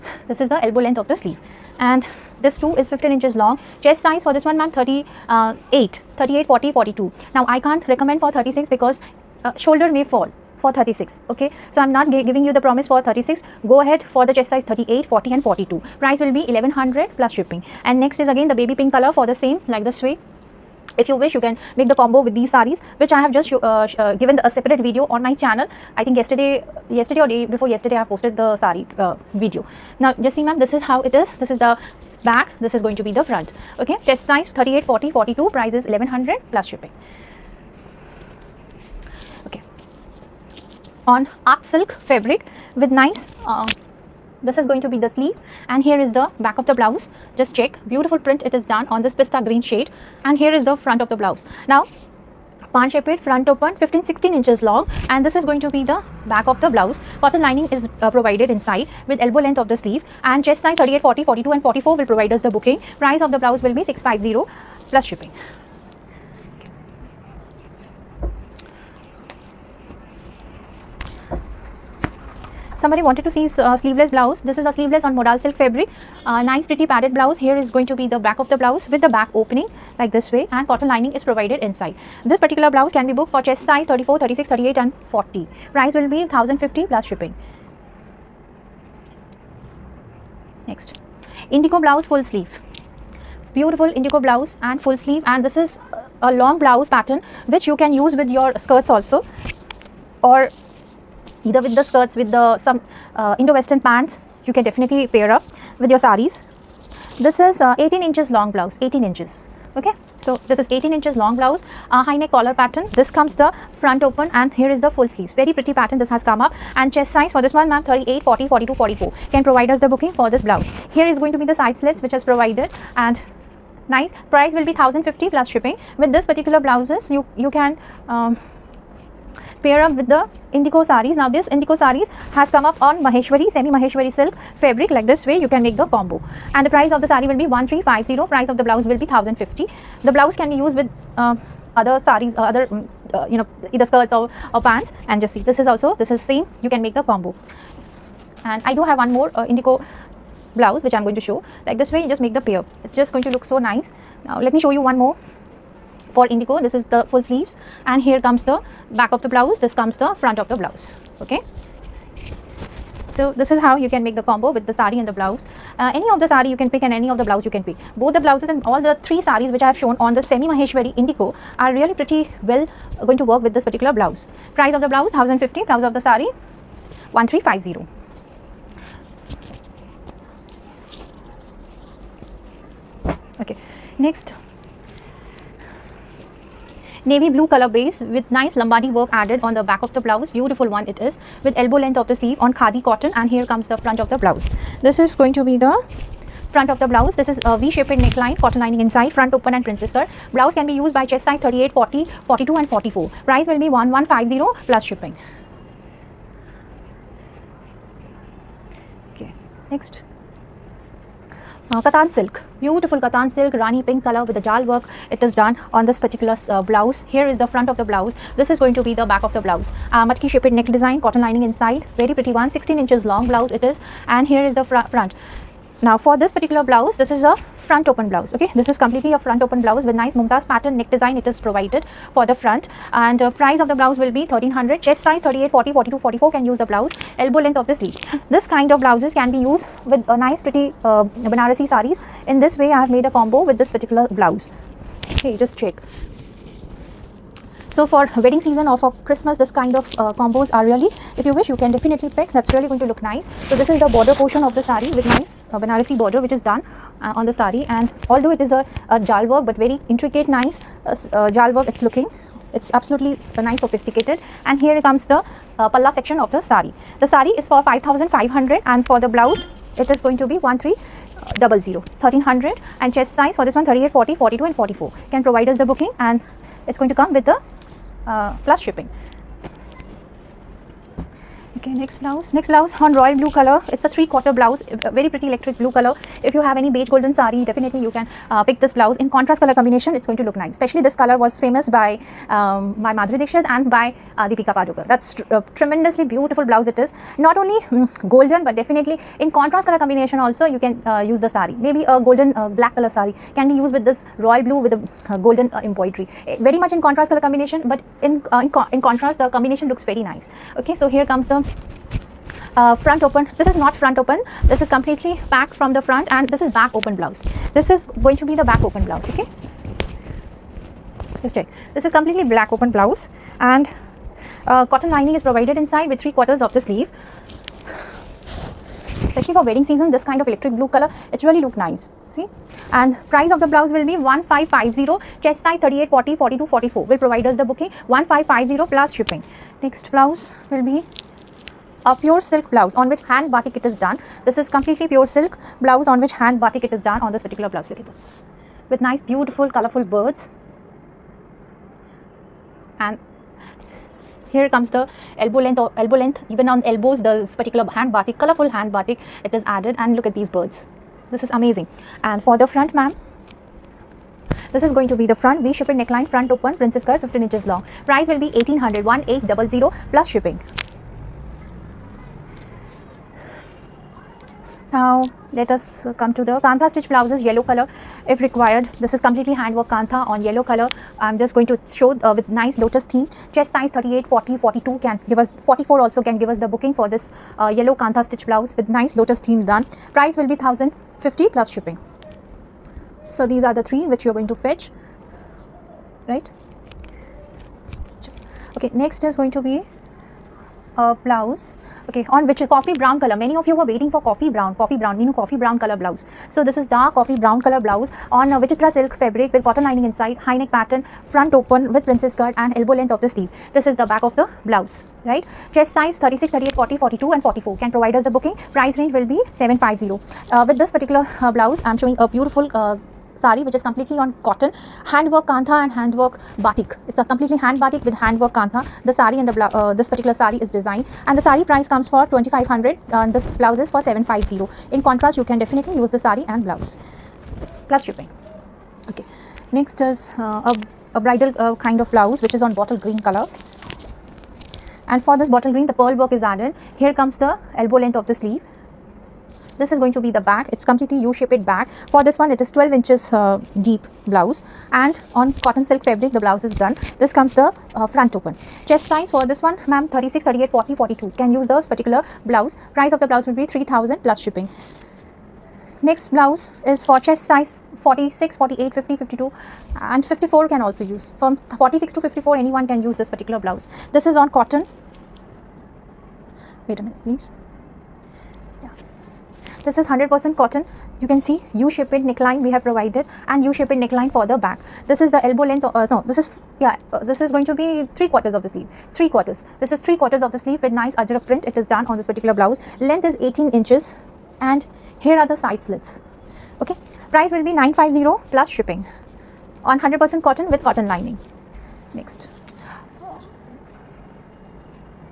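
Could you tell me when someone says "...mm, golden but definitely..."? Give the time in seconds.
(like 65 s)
297 s.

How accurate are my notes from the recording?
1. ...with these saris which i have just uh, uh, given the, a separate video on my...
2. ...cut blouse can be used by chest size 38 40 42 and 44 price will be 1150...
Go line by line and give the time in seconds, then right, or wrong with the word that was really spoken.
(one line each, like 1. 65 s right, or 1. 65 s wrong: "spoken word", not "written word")
1. 22 s right
2. 199 s right.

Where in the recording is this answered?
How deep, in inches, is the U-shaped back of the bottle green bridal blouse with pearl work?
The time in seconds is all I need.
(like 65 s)
452 s.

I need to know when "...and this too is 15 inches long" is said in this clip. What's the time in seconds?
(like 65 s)
1 s.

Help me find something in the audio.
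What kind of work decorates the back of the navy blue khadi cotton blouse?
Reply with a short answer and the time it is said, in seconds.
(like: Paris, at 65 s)
Lambani work, at 188 s.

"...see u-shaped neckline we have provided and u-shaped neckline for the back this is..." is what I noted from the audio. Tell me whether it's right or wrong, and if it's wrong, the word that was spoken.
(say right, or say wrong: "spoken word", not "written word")
right.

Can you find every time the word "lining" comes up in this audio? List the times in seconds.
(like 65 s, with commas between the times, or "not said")
57 s, 80 s, 198 s, 221 s, 324 s, 409 s, 500 s.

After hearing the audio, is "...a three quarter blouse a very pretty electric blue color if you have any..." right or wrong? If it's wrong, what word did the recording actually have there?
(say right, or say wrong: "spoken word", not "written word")
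right.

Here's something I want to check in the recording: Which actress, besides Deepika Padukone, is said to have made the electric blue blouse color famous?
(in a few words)
Madhuri Dixit.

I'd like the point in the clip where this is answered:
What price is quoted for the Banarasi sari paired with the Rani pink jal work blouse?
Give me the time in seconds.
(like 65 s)
267 s.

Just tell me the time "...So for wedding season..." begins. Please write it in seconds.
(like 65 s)
247 s.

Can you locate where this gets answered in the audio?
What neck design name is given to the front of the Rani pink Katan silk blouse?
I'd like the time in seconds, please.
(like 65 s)
230 s.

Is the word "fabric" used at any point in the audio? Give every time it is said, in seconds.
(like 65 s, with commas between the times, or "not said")
42 s, 75 s, 134 s, 409 s, 455 s.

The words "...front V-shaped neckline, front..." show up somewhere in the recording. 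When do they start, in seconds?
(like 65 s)
365 s.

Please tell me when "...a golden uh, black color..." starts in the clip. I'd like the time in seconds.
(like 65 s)
301 s.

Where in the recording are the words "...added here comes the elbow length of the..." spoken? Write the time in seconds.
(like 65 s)
446 s.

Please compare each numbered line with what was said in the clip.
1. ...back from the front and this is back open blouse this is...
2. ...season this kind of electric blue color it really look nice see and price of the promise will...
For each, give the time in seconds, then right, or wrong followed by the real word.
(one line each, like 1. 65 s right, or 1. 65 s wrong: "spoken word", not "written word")
1. 315 s right
2. 329 s wrong: "blouse", not "promise".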